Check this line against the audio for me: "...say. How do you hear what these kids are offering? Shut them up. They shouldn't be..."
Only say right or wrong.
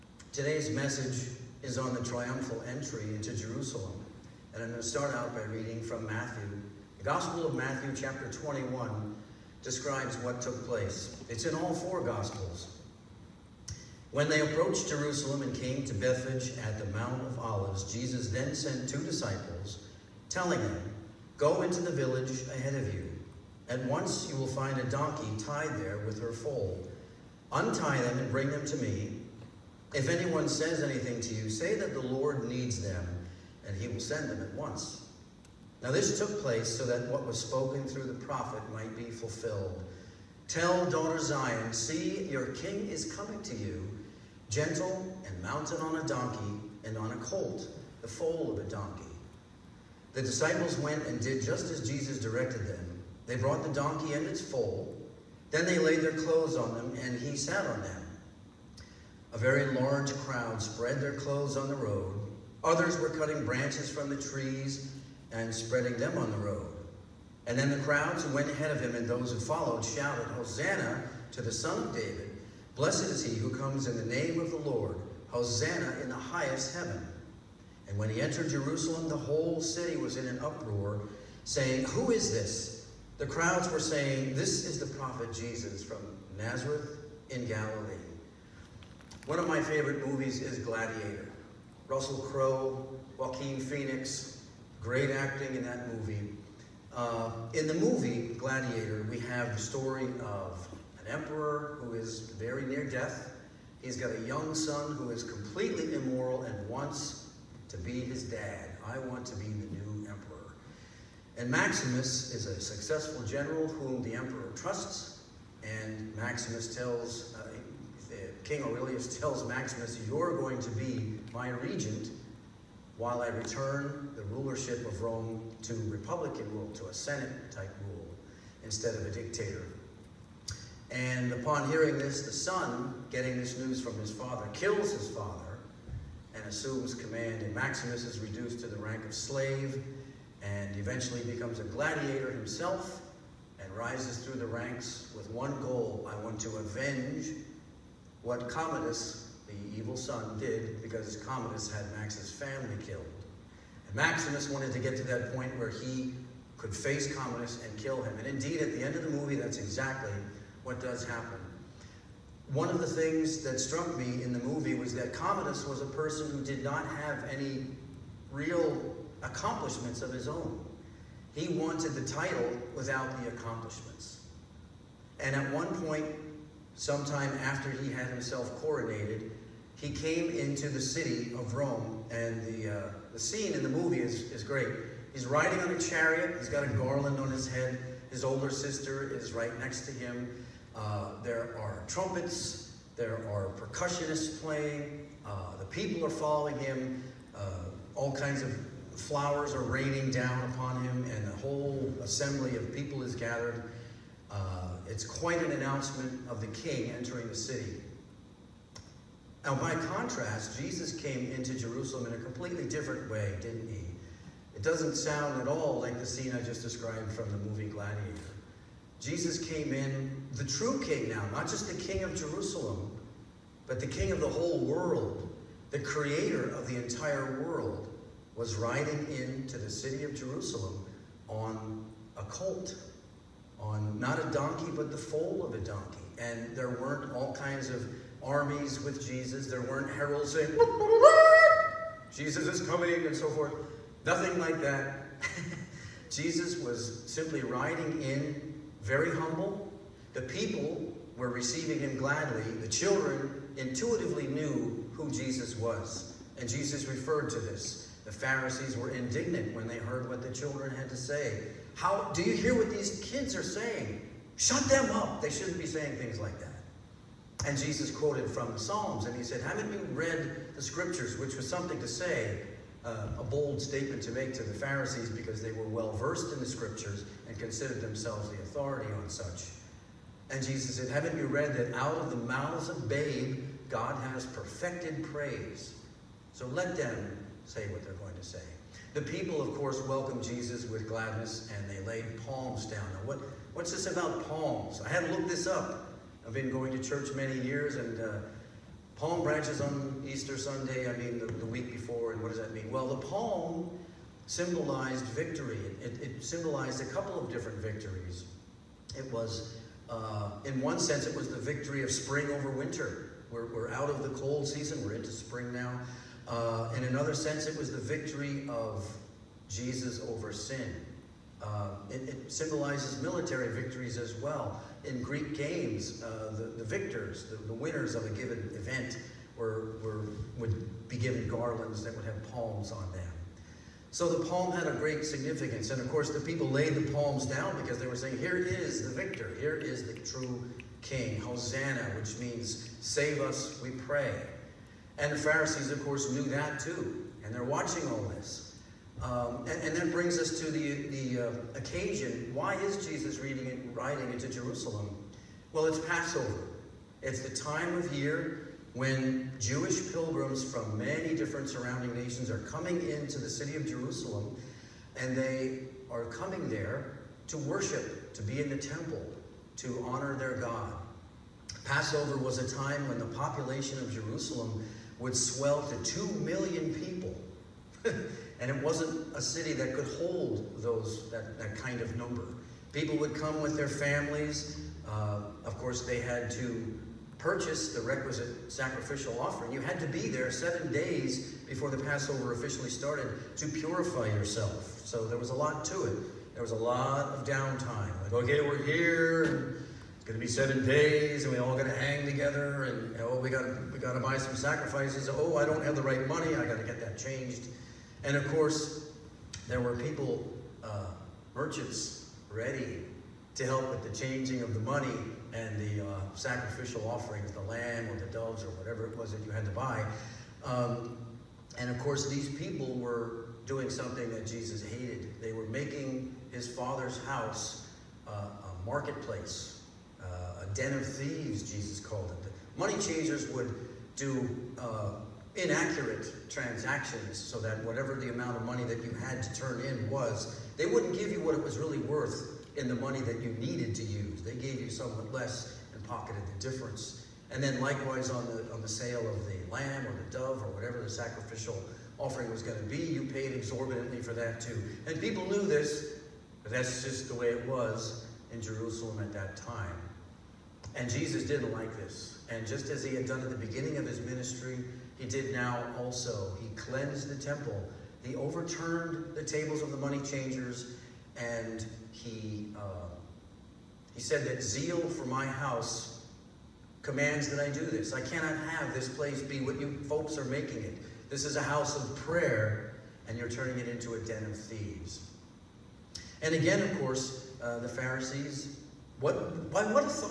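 wrong.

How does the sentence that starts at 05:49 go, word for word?
Um, and, and, that brings us to the, the uh, occasion.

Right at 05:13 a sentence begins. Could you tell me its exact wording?
We're, we're out of the cold season, we're into spring now.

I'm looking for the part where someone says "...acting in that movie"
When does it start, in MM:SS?
01:35.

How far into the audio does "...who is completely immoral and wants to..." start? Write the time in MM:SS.
01:44.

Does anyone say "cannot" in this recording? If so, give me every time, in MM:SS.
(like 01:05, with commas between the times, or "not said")
07:58.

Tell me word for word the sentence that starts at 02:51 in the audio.
He wanted the title without the accomplishments.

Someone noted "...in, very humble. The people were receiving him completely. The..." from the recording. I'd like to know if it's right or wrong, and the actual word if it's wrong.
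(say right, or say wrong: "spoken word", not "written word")
wrong: "gladly", not "completely".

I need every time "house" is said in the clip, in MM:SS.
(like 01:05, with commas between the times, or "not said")
07:07, 07:55, 08:01.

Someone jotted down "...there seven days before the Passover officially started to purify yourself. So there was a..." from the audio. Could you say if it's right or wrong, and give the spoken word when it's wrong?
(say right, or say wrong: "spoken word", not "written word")
right.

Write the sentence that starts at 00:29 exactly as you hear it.
If anyone says anything to you, say that the Lord needs them, and he will send them at once.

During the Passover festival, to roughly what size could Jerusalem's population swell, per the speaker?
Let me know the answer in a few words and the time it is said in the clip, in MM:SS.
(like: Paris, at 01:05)
2 million, at 06:15.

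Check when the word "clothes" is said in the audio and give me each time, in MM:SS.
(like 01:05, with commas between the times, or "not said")
00:56, 01:01.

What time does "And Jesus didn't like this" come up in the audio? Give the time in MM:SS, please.
07:40.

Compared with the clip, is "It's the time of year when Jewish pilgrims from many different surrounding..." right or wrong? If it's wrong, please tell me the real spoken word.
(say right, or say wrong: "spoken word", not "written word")
right.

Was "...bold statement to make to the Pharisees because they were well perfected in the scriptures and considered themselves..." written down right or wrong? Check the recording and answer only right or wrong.
wrong.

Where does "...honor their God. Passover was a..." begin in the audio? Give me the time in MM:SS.
06:09.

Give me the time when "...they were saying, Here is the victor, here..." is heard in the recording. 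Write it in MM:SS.
05:37.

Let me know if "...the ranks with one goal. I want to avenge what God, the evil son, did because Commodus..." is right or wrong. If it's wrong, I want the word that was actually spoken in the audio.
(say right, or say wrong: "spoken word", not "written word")
wrong: "Commodus", not "God".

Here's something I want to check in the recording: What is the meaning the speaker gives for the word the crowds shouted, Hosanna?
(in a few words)
Save us, we pray.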